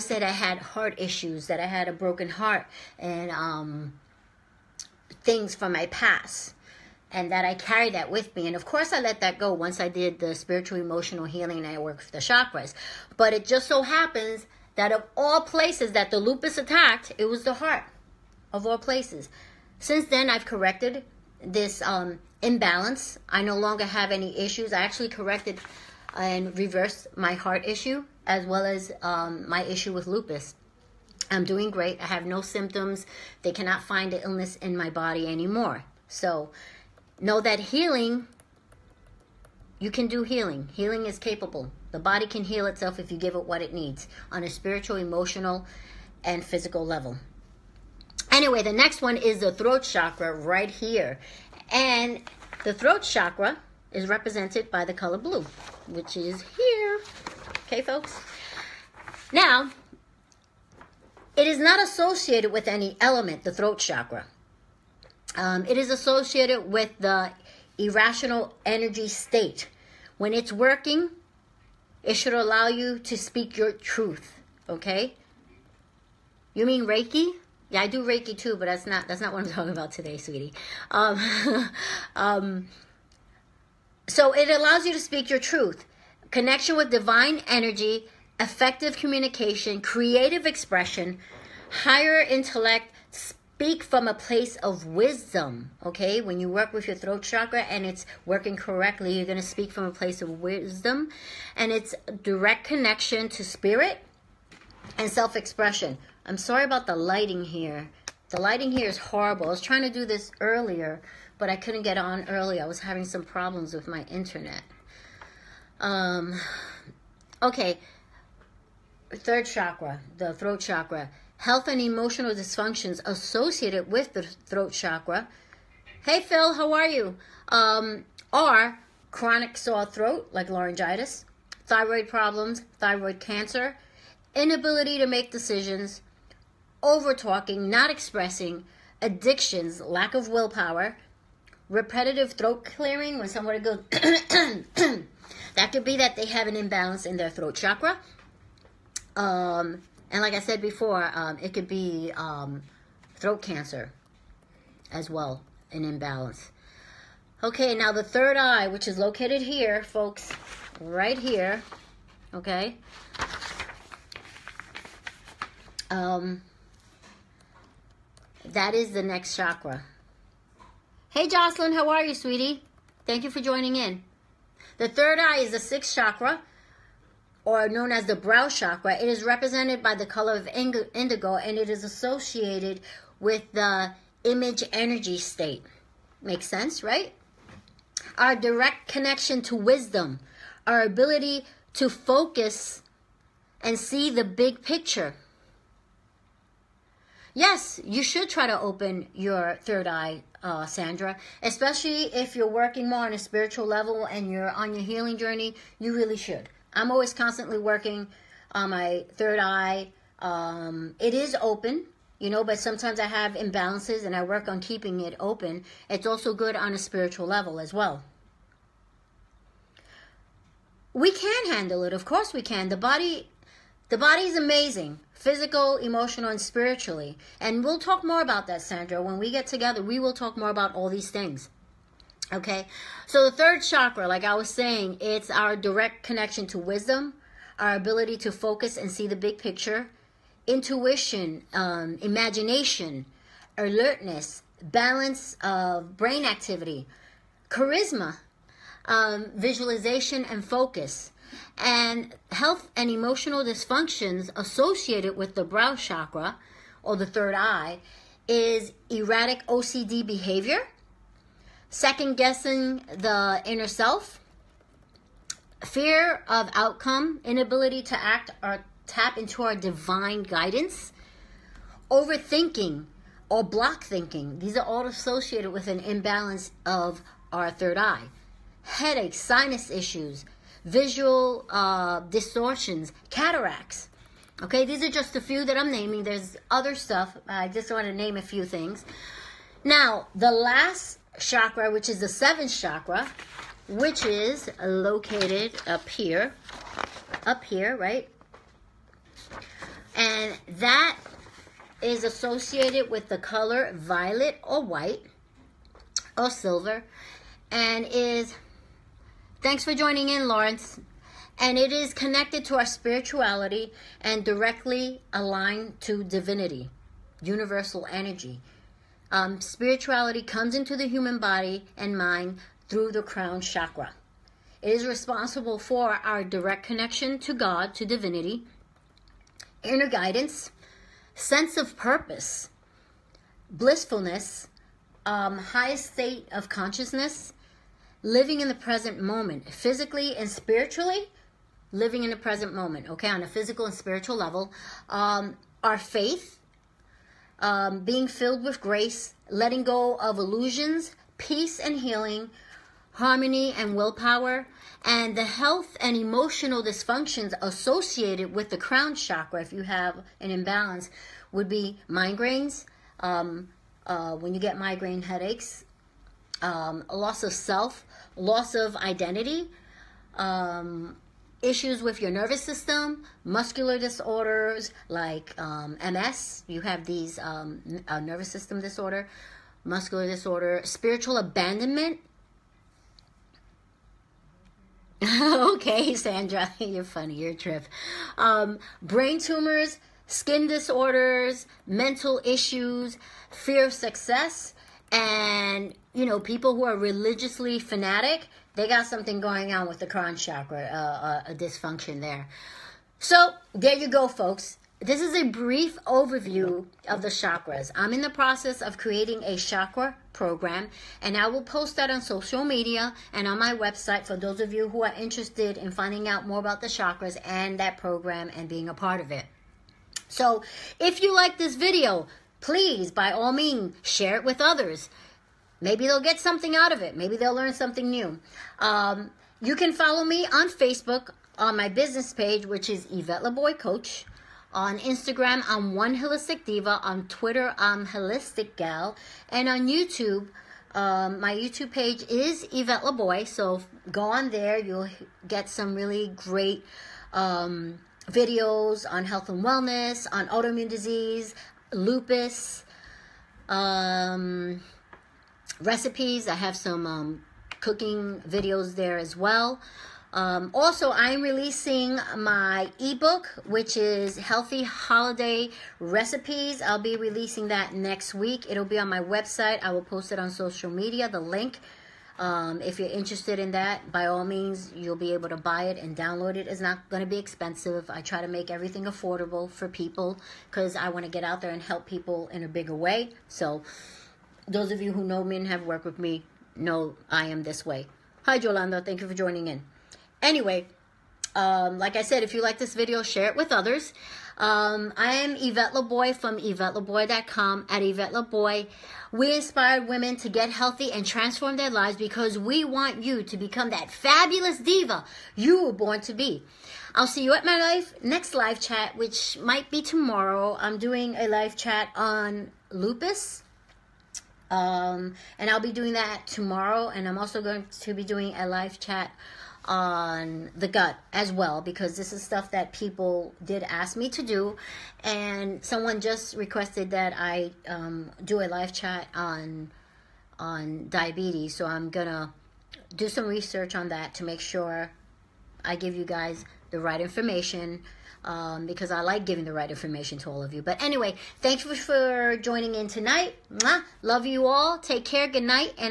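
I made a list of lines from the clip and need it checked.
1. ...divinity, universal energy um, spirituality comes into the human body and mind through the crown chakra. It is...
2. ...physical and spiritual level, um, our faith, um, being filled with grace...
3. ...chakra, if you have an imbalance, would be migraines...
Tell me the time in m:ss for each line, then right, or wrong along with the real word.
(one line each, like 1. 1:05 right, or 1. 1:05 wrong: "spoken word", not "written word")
1. 5:16 right
2. 5:43 right
3. 5:58 right.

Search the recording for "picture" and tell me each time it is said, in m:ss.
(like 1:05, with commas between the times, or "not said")
3:14, 3:59.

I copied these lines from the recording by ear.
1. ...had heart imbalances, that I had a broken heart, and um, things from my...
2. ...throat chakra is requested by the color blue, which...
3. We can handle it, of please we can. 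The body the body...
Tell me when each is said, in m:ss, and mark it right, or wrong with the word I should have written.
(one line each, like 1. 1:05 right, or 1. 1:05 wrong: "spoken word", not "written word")
1. 0:00 wrong: "issues", not "imbalances"
2. 0:52 wrong: "represented", not "requested"
3. 3:40 wrong: "course", not "please".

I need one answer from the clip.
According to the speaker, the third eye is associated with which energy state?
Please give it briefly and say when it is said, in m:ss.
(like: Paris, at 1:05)
image, at 3:04.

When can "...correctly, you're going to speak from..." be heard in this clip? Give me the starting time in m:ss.
1:38.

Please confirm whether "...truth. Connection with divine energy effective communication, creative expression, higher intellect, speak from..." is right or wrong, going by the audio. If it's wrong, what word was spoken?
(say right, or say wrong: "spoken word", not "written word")
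right.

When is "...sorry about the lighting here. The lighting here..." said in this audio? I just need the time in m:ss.
1:46.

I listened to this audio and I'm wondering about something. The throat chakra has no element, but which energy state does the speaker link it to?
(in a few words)
irrational.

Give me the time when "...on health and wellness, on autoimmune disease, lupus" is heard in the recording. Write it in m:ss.
7:28.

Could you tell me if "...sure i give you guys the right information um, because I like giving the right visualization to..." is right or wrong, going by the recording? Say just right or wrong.
wrong.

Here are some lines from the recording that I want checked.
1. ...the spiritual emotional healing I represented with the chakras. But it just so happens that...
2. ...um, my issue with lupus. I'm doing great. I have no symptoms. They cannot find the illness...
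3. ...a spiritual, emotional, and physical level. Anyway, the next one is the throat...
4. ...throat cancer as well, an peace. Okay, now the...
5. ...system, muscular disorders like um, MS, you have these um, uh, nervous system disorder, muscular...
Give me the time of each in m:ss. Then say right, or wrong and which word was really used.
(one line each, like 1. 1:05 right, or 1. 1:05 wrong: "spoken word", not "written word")
1. 0:10 wrong: "worked", not "represented"
2. 0:29 right
3. 0:44 right
4. 2:33 wrong: "imbalance", not "peace"
5. 6:12 right.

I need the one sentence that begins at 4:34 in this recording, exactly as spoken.
These are all associated with an imbalance of our third eye.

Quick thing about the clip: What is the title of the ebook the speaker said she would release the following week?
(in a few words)
Healthy Holiday Recipes.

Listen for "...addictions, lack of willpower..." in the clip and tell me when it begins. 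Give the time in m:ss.
2:18.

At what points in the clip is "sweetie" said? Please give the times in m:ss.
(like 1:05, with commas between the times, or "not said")
1:20, 2:52.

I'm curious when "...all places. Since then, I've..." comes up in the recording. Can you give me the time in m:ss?
0:18.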